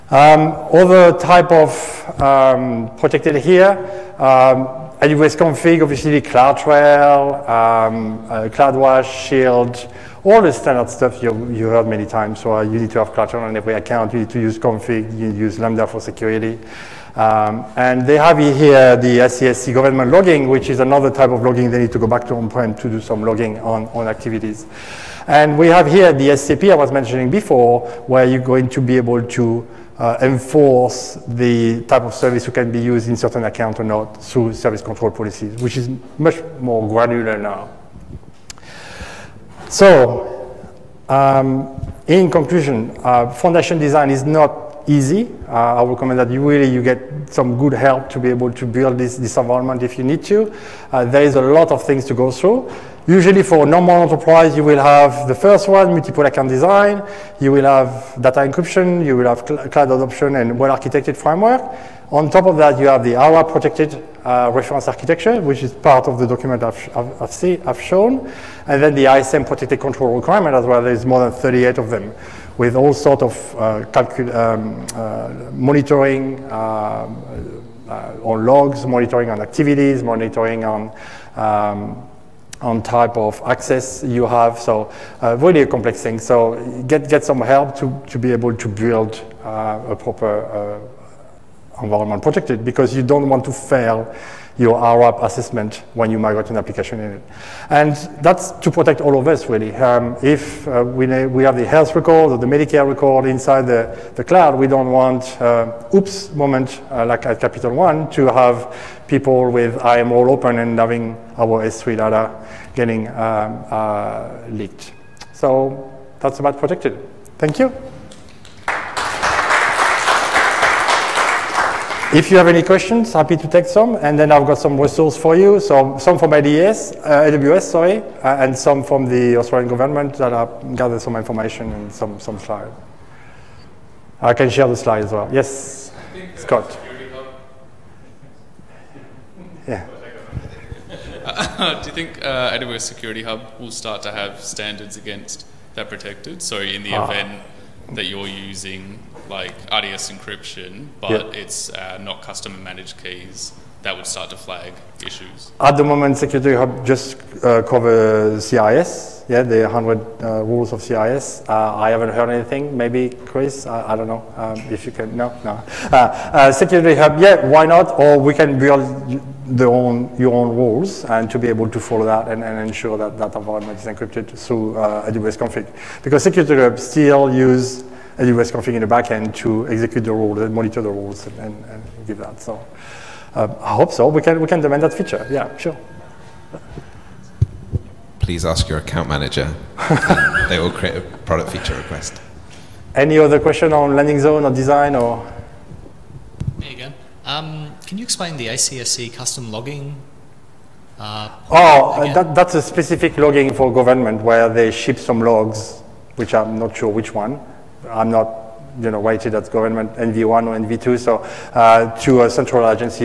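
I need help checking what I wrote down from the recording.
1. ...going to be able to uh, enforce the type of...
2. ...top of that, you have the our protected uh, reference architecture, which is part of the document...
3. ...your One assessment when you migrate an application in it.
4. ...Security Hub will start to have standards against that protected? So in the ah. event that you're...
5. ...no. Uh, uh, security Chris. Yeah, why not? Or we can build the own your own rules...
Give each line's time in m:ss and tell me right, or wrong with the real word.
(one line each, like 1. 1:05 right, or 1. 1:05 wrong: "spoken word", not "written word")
1. 0:28 right
2. 1:02 right
3. 1:34 wrong: "IRAP", not "One"
4. 2:22 right
5. 2:45 wrong: "Hub", not "Chris".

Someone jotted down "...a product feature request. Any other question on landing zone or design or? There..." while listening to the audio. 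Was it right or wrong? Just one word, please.
right.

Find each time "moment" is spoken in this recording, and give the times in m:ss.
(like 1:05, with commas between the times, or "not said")
1:46, 2:35.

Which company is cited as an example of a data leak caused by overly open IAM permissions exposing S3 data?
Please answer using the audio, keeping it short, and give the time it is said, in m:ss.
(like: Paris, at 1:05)
Capital One, at 1:47.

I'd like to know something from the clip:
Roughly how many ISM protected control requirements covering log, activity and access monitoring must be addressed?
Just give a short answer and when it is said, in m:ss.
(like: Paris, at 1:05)
more than 38, at 1:11.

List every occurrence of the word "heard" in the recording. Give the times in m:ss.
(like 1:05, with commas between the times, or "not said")
0:11, 2:42.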